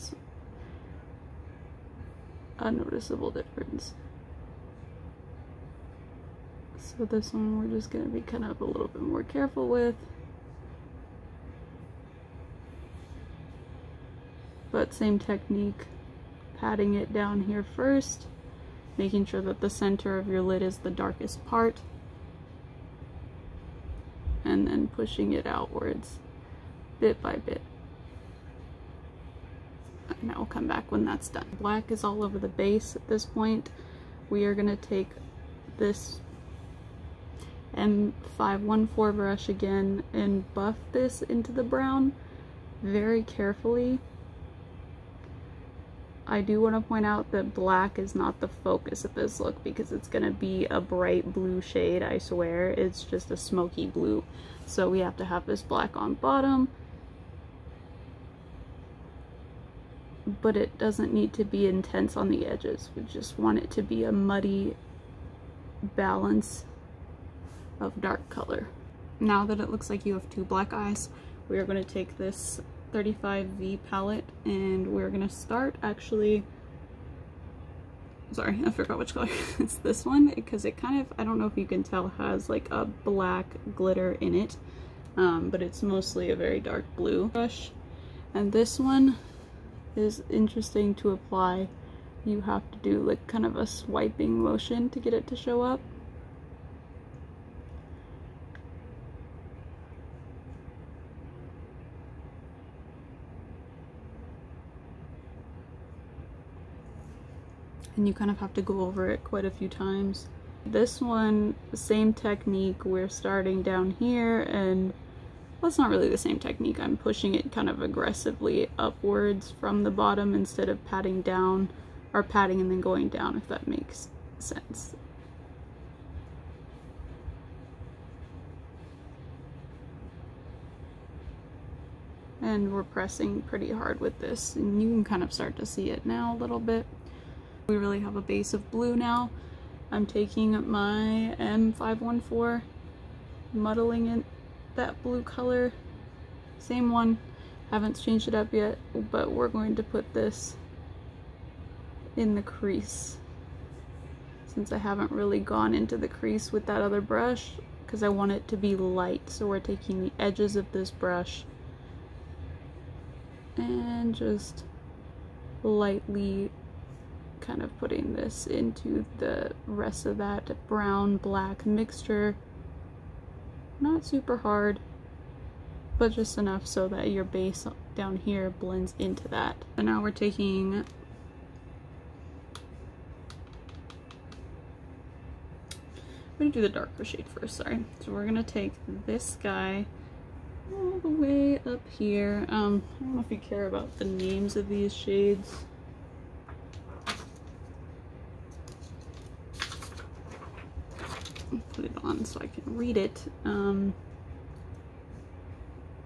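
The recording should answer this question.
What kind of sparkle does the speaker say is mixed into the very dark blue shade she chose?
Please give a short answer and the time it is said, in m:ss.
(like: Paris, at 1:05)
black glitter, at 1:22.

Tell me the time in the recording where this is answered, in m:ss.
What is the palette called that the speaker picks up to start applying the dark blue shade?
1:12.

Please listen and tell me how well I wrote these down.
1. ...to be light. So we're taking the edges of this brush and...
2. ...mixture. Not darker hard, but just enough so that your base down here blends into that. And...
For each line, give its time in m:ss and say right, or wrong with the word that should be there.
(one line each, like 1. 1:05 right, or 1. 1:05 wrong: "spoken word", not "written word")
1. 2:38 right
2. 2:51 wrong: "super", not "darker".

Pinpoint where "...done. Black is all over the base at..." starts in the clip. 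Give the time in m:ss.
0:31.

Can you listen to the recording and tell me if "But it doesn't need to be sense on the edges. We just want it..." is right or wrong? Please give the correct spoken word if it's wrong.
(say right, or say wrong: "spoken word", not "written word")
wrong: "intense", not "sense".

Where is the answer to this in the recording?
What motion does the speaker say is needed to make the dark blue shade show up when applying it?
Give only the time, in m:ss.
1:33.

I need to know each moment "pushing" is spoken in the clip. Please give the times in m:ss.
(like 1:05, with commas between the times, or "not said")
0:24, 1:56.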